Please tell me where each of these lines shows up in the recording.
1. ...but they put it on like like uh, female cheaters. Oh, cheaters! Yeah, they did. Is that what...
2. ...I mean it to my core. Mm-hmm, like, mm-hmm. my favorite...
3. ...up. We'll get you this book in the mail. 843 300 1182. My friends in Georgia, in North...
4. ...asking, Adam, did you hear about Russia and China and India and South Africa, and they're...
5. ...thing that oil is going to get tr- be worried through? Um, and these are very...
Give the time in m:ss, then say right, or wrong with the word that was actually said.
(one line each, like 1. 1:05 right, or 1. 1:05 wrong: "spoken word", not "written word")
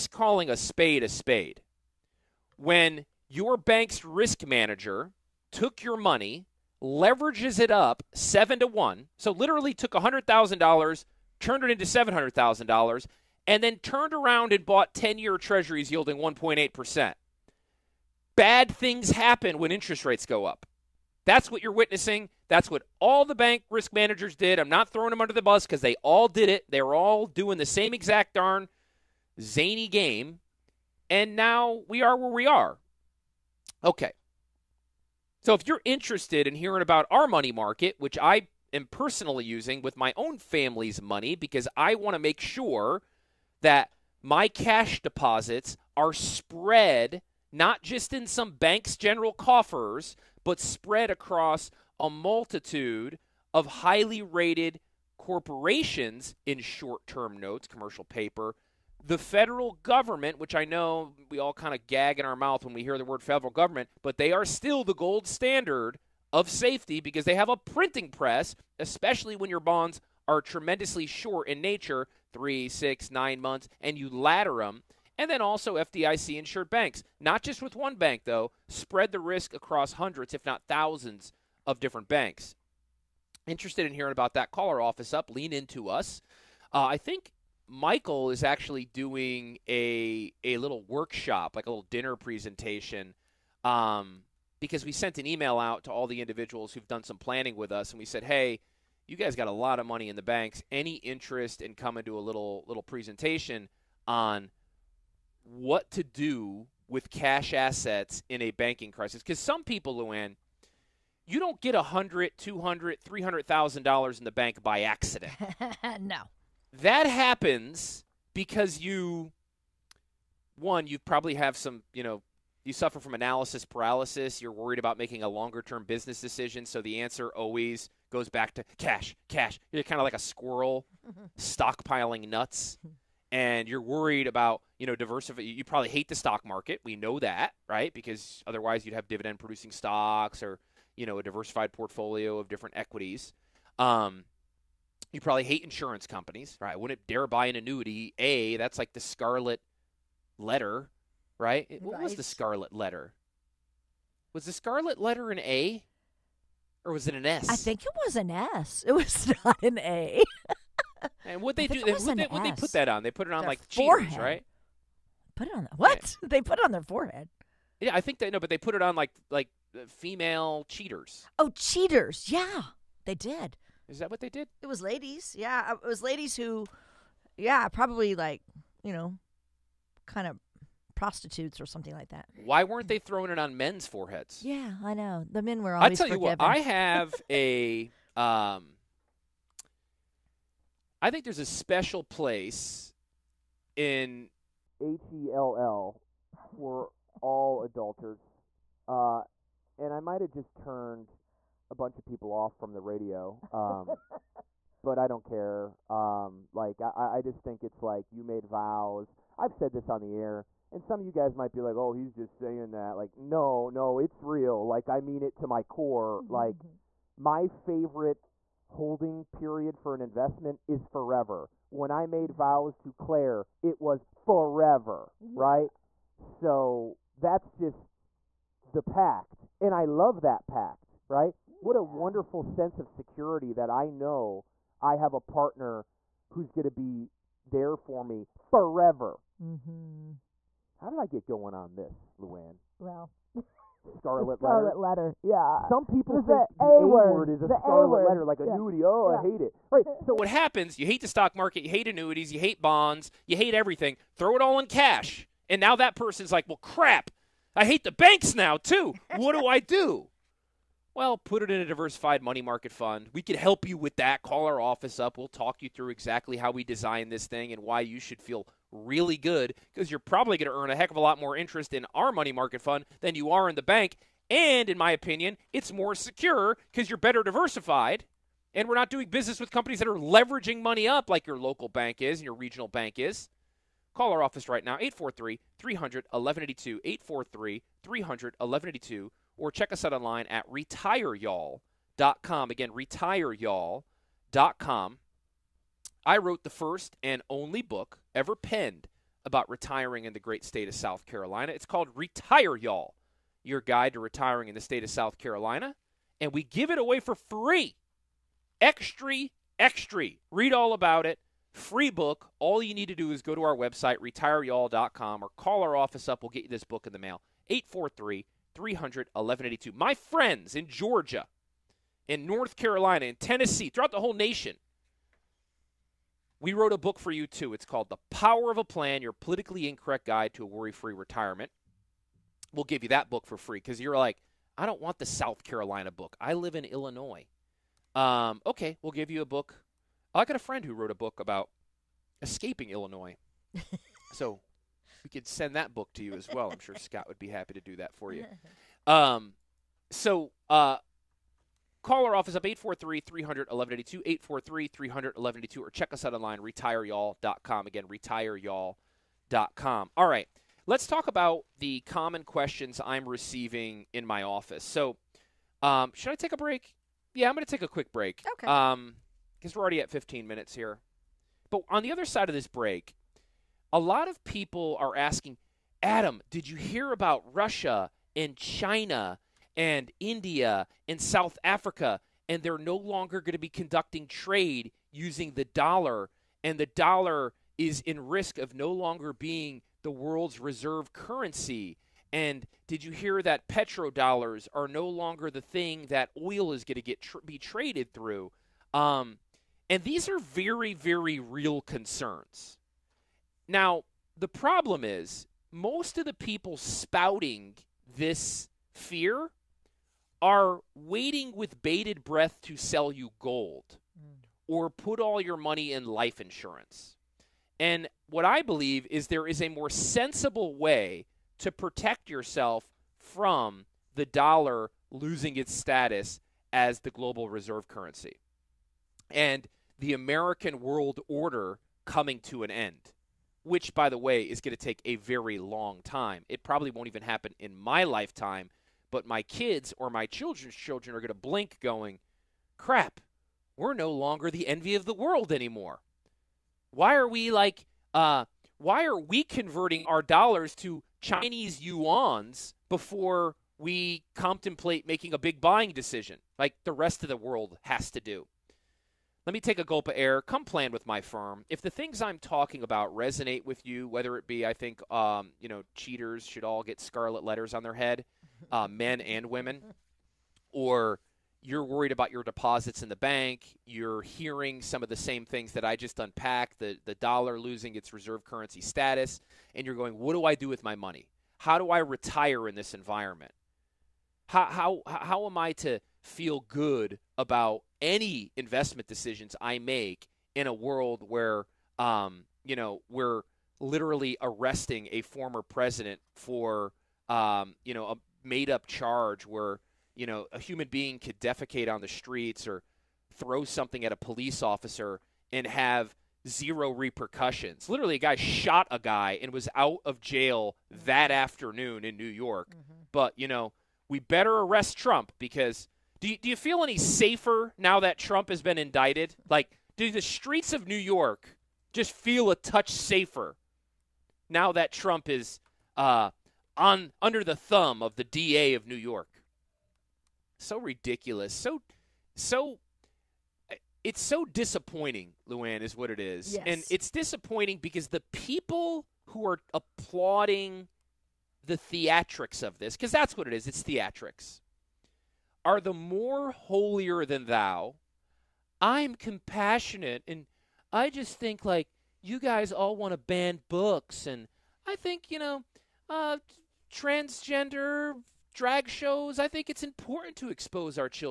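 1. 2:48 right
2. 3:34 right
3. 5:16 right
4. 6:14 right
5. 6:35 wrong: "traded", not "worried".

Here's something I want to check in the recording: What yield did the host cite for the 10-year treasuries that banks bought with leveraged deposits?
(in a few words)
1.8%.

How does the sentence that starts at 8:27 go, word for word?
Literally, a guy shot a guy and was out of jail that afternoon in New York.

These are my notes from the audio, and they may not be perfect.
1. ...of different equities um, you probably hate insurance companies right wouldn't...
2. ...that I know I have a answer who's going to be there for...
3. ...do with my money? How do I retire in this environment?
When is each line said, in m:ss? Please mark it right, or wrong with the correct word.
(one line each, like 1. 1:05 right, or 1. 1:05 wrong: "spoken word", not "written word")
1. 2:22 right
2. 3:53 wrong: "partner", not "answer"
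3. 8:00 right.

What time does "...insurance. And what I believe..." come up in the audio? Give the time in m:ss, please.
6:56.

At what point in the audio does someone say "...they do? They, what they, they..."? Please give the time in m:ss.
2:41.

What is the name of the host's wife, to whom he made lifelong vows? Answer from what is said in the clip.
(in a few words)
Claire.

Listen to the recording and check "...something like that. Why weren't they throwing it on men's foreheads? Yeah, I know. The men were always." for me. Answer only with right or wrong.
right.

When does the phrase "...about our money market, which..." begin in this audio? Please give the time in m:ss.
0:36.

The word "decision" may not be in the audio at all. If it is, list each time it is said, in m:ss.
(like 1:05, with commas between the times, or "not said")
2:06, 7:35, 8:08.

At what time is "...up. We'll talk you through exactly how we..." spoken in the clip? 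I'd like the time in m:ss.
4:24.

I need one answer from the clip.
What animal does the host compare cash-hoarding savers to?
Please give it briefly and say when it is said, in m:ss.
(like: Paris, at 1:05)
A squirrel, at 2:10.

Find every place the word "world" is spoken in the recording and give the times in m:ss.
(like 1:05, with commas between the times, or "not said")
6:29, 7:10, 7:24, 7:37, 8:10.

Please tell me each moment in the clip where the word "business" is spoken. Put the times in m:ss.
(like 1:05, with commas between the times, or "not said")
2:05, 4:39.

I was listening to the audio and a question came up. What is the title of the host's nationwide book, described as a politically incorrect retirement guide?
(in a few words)
The Power of a Plan.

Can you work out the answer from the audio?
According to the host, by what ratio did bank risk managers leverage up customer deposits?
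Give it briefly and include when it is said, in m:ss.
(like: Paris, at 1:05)
7 to 1, at 0:08.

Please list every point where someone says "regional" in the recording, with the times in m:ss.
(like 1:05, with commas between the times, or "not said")
4:42.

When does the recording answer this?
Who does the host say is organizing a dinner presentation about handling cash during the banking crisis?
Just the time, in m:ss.
1:27.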